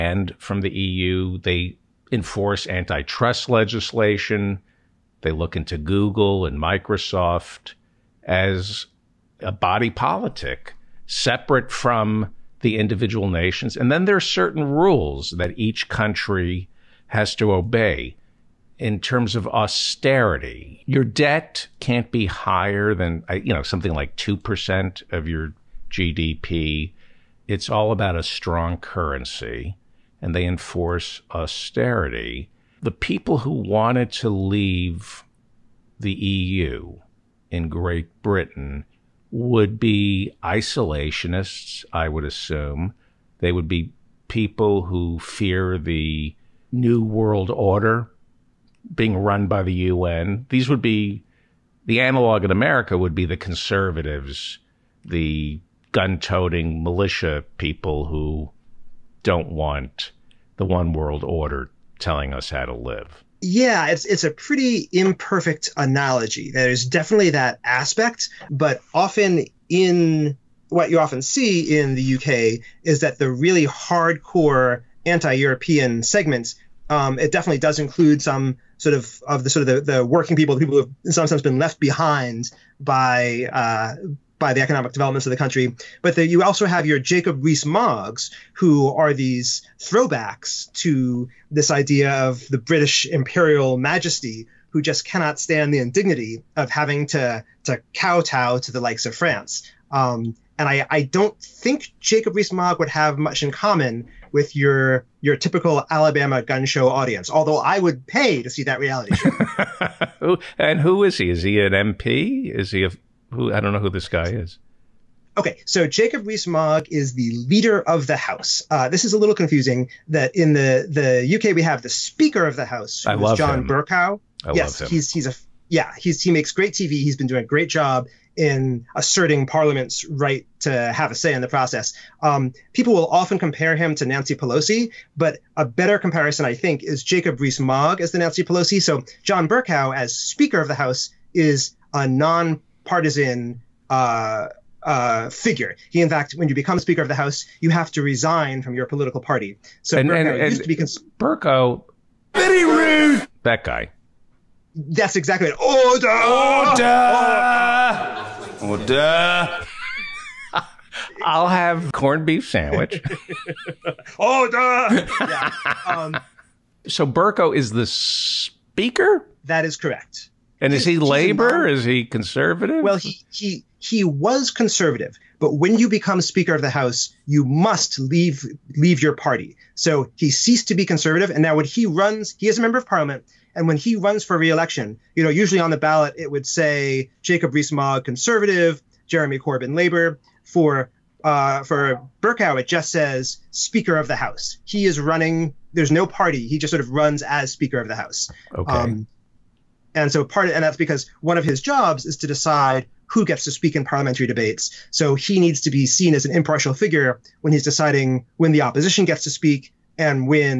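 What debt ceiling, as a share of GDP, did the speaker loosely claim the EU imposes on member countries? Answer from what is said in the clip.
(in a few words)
2%.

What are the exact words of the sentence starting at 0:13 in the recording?
And then there are certain rules that each country has to obey in terms of austerity.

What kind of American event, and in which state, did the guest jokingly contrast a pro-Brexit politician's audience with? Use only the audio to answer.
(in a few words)
Alabama gun show.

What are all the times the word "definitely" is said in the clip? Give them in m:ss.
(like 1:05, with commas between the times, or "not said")
1:06, 1:17.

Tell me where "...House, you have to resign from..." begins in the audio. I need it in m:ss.
2:27.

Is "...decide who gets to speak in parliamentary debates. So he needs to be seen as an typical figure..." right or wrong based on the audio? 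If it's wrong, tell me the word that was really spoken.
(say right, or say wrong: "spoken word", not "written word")
wrong: "impartial", not "typical".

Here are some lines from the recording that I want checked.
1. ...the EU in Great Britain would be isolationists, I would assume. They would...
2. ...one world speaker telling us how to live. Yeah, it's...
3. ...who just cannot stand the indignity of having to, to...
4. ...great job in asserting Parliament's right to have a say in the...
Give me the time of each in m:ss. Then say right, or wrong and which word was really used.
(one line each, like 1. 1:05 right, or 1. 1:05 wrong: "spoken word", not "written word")
1. 0:35 right
2. 1:00 wrong: "order", not "speaker"
3. 1:34 right
4. 2:07 right.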